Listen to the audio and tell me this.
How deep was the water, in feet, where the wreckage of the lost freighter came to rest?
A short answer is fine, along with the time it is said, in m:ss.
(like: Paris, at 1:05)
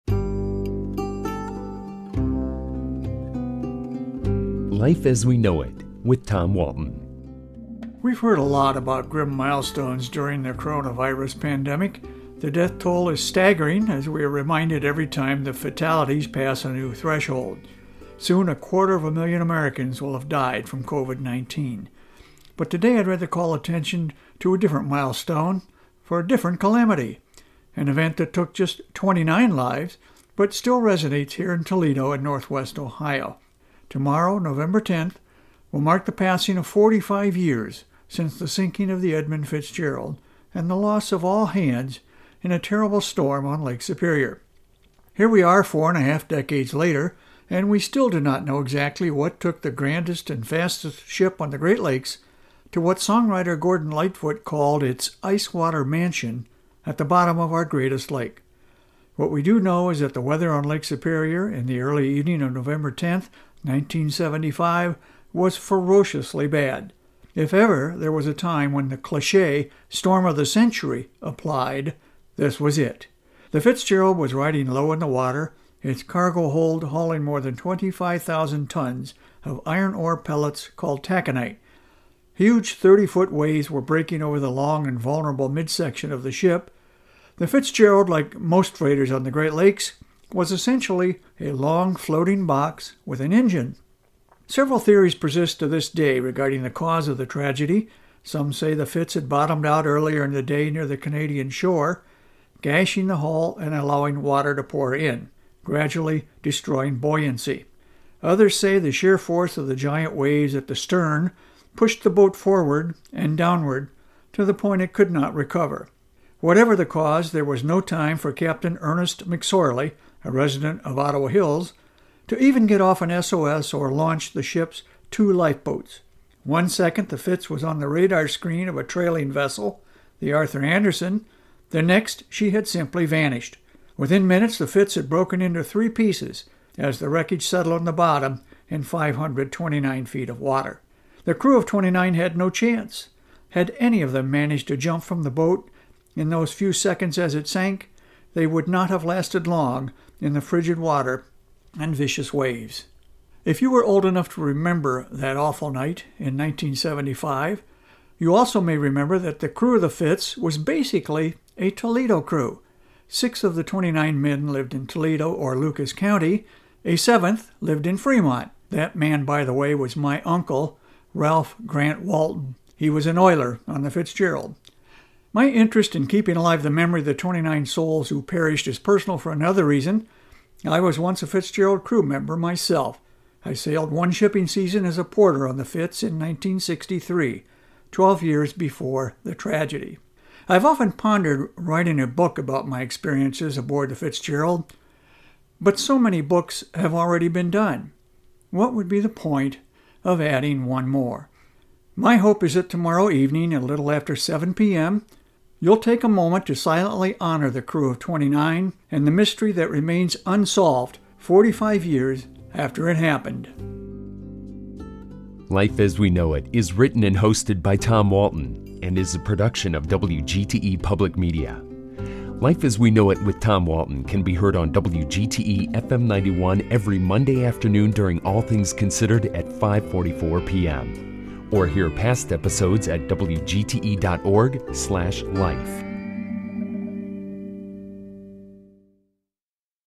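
529, at 2:18.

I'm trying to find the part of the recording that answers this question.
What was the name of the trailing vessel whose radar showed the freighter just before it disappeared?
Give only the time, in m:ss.
2:10.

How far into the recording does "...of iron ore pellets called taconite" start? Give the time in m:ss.
1:19.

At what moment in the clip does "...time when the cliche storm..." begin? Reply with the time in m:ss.
1:08.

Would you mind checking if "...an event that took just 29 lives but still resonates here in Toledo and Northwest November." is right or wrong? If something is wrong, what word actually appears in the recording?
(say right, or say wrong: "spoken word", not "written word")
wrong: "Ohio", not "November".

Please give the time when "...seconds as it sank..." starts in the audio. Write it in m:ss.
2:26.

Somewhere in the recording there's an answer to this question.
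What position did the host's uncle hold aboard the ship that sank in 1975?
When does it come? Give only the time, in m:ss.
2:53.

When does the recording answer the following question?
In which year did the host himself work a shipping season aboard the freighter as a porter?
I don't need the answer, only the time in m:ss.
3:06.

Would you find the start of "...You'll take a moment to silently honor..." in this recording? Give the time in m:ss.
3:25.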